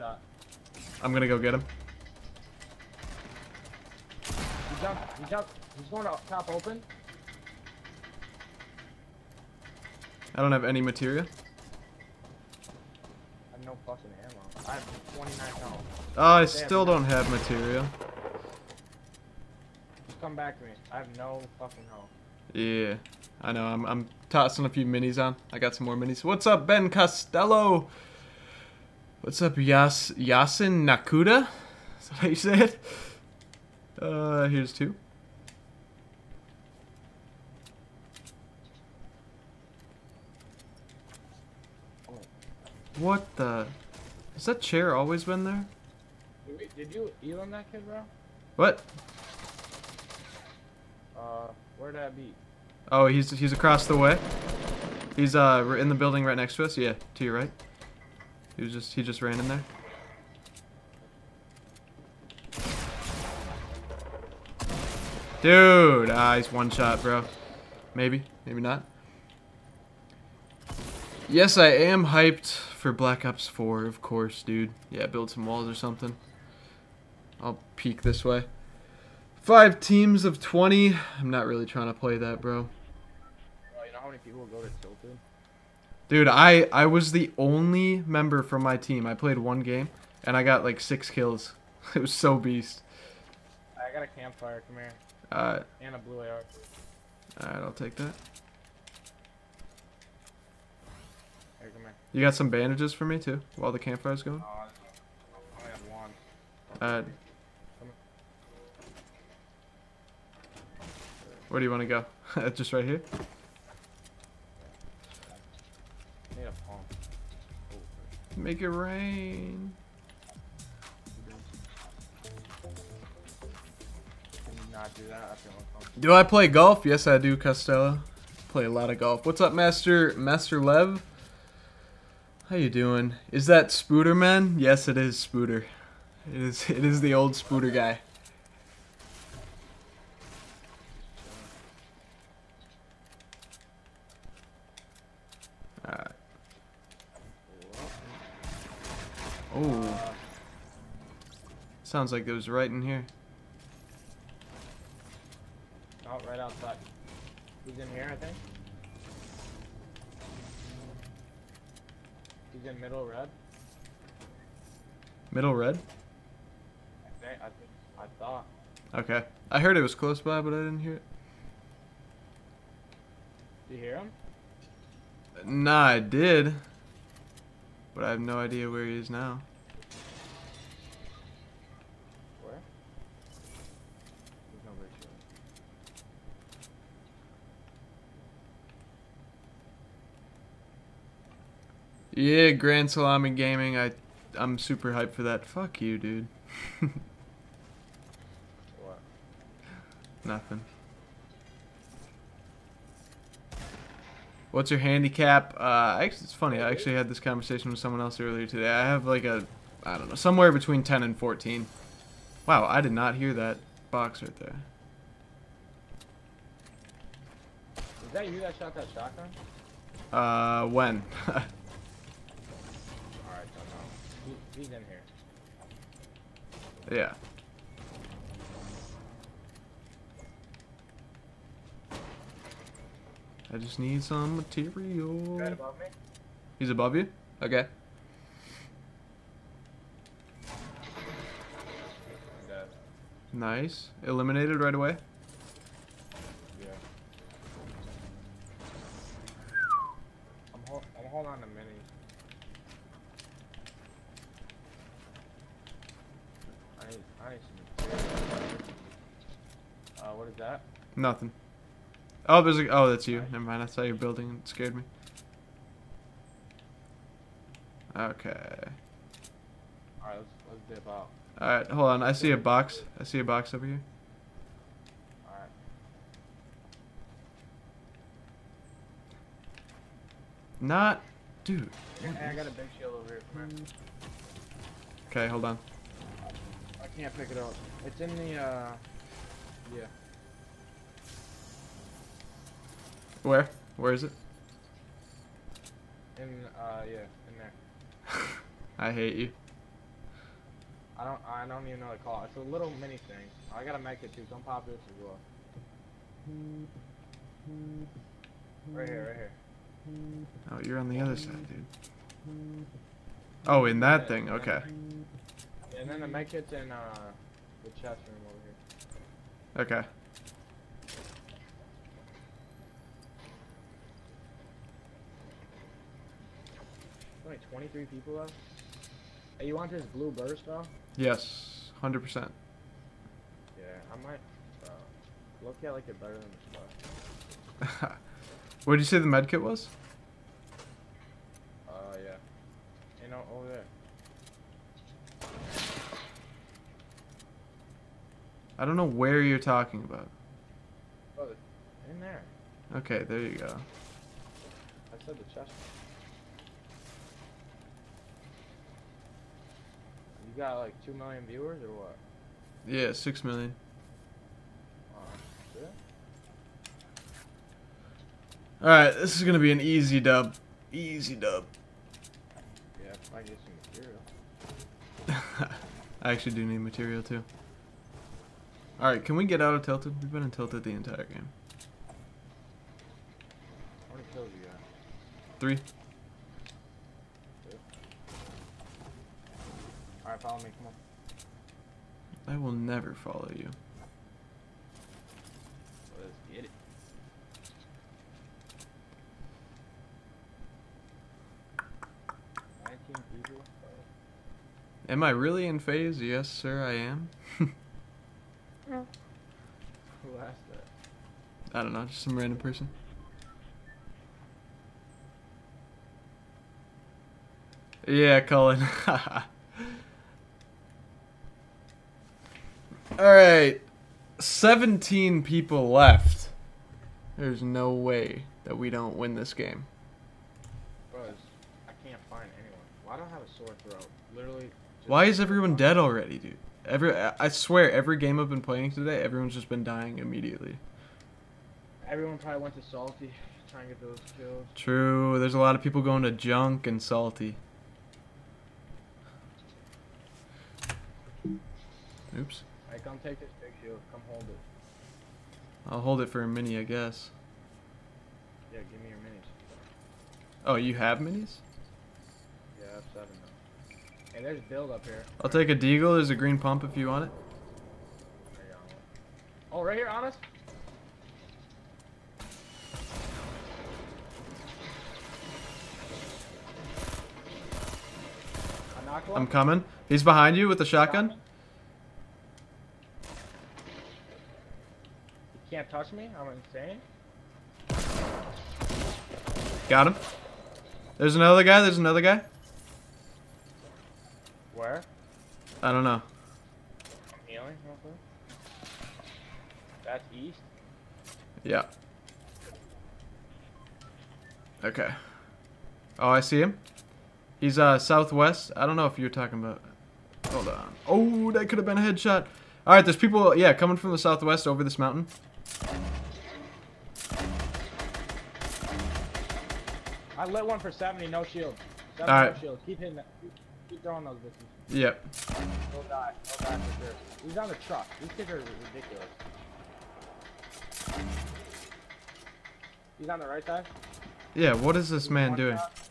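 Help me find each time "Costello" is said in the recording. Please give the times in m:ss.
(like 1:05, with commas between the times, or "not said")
0:26, 2:07.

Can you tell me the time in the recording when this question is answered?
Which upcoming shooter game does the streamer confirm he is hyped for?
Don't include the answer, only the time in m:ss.
1:12.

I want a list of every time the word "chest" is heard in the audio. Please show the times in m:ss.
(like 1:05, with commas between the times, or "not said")
5:17, 5:55.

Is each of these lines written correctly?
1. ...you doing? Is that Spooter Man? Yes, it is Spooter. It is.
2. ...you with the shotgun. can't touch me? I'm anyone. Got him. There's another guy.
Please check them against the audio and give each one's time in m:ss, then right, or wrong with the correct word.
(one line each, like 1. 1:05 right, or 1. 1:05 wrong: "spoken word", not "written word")
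1. 2:12 right
2. 8:00 wrong: "insane", not "anyone".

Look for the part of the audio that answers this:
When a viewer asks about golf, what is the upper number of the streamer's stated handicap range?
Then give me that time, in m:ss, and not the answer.
3:30.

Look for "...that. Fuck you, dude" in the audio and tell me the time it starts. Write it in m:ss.
3:15.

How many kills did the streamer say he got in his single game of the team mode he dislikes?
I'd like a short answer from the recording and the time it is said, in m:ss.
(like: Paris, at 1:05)
6, at 1:30.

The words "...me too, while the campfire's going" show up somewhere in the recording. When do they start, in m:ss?
1:43.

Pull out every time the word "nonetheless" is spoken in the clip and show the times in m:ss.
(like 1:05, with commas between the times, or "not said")
not said.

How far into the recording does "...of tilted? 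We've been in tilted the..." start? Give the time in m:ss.
6:19.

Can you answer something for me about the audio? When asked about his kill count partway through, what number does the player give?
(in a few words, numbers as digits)
3.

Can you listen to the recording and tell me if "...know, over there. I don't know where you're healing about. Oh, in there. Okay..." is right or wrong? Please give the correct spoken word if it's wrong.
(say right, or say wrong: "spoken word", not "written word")
wrong: "talking", not "healing".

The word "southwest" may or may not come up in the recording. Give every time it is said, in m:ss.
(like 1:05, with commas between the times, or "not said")
8:27, 8:33.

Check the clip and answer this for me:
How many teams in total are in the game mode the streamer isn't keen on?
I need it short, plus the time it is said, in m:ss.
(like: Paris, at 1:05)
5, at 1:19.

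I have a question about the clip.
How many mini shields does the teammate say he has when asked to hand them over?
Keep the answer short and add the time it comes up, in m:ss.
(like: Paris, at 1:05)
7, at 7:42.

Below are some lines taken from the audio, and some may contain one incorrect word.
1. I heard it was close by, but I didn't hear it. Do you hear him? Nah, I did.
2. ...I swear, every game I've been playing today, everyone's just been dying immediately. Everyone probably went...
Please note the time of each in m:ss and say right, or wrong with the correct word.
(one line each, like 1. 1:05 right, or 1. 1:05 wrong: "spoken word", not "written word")
1. 2:49 right
2. 7:16 right.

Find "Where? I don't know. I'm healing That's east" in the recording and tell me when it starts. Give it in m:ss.
8:14.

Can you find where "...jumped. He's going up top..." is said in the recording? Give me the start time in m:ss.
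0:05.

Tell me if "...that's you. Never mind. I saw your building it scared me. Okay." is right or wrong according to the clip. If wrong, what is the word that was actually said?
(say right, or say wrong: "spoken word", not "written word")
right.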